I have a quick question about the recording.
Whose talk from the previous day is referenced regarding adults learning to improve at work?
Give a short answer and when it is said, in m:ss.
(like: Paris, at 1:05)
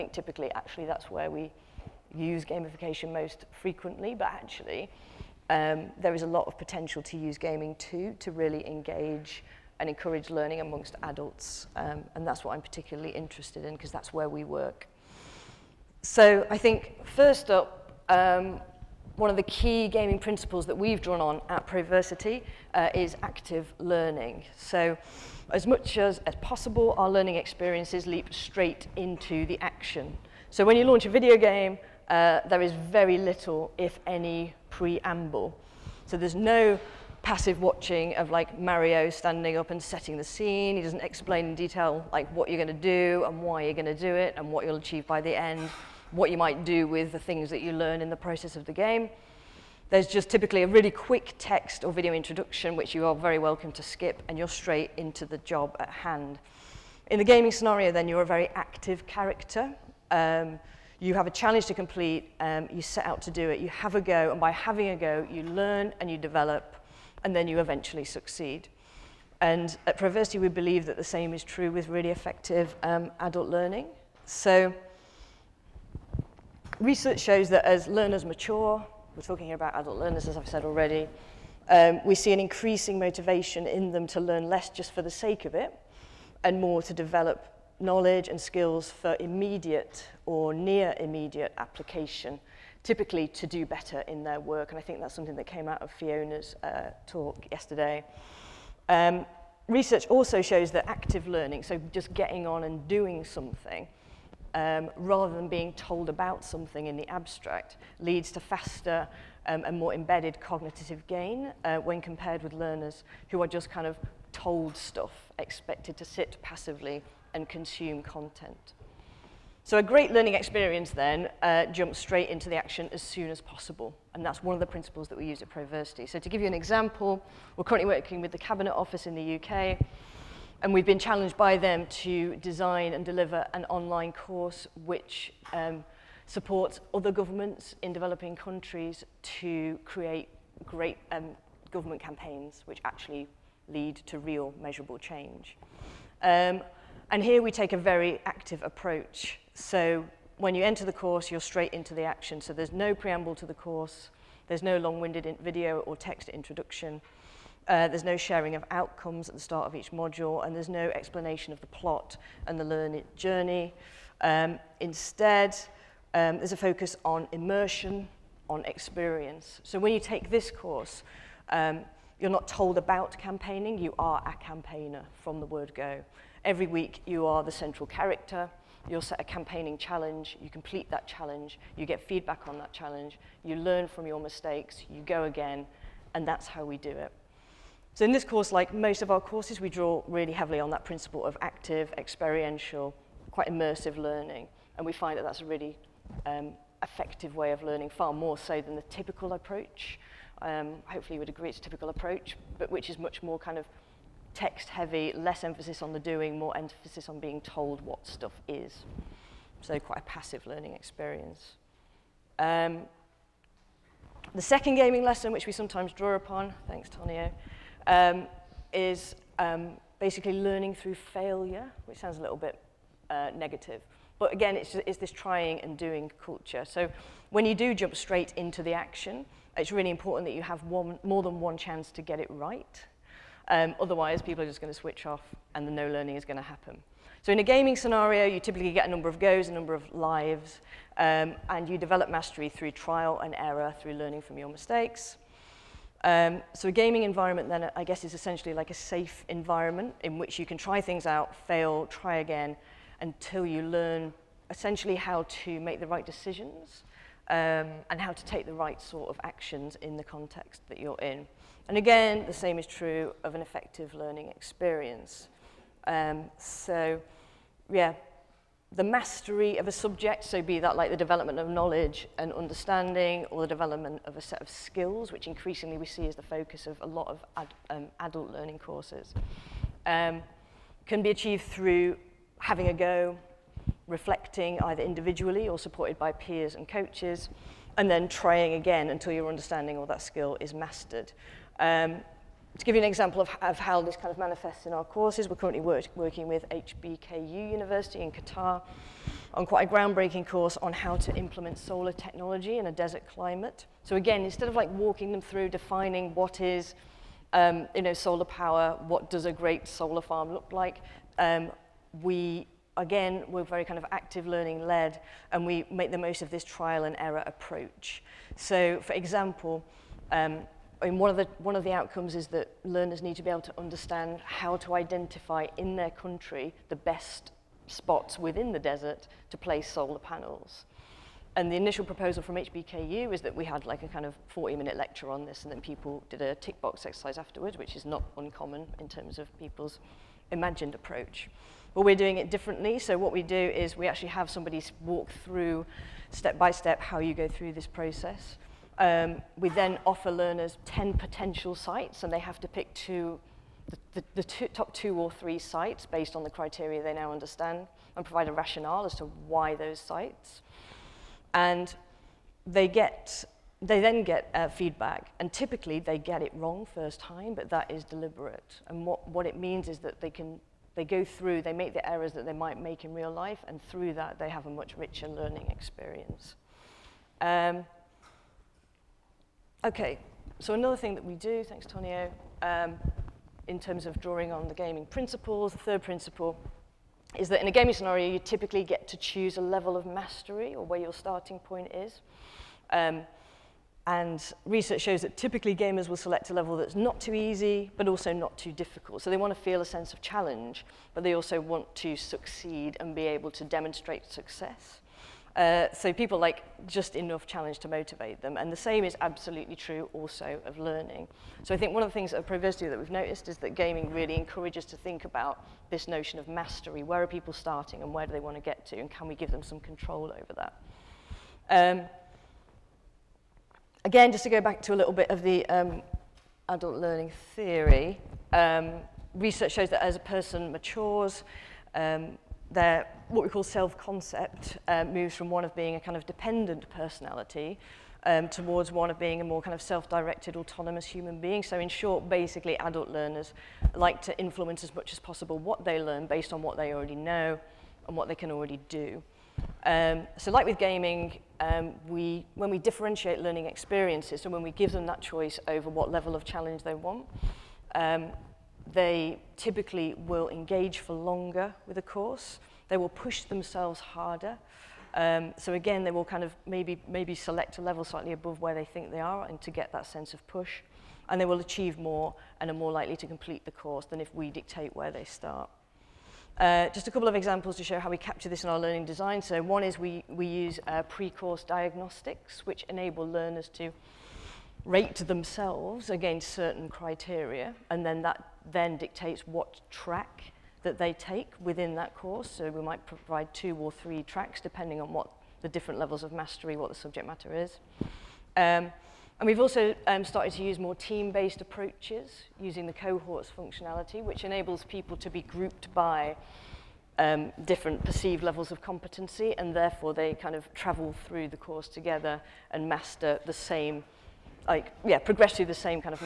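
Fiona, at 1:35.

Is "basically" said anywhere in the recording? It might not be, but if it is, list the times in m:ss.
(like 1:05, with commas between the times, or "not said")
3:39, 7:22.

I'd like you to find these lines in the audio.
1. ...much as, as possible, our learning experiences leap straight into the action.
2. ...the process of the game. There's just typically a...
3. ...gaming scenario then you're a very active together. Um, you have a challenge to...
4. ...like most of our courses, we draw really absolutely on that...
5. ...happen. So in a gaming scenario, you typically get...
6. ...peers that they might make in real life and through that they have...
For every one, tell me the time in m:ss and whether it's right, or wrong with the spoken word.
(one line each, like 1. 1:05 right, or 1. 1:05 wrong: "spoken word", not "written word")
1. 0:25 right
2. 0:48 right
3. 0:57 wrong: "character", not "together"
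4. 3:08 wrong: "heavily", not "absolutely"
5. 3:56 right
6. 6:11 wrong: "errors", not "peers".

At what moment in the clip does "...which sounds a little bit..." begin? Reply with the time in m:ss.
3:41.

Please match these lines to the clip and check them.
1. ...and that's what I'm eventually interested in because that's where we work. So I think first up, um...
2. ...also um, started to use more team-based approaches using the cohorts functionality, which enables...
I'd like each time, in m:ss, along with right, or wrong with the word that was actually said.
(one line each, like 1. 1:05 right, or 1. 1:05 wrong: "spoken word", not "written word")
1. 0:12 wrong: "particularly", not "eventually"
2. 8:19 right.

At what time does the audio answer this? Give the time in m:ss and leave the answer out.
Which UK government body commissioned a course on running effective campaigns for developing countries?
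2:08.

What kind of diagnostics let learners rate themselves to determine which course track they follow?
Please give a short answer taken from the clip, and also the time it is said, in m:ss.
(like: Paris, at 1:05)
Pre-course diagnostics, at 8:00.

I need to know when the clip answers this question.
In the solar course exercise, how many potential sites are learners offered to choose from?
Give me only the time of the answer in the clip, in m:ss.
5:50.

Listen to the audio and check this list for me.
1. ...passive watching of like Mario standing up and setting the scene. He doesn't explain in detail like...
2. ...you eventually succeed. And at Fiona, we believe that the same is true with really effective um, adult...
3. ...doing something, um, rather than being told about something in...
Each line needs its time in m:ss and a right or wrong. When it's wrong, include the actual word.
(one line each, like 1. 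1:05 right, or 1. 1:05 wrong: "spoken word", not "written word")
1. 0:37 right
2. 1:07 wrong: "Proversity", not "Fiona"
3. 1:42 right.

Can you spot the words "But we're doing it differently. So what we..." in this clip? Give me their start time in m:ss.
5:41.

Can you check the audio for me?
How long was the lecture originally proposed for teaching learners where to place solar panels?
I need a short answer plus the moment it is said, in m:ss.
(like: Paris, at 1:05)
40 minutes, at 5:34.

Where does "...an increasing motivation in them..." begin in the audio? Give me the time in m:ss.
1:22.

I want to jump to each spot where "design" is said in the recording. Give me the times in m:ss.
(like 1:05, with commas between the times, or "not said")
2:12, 7:58.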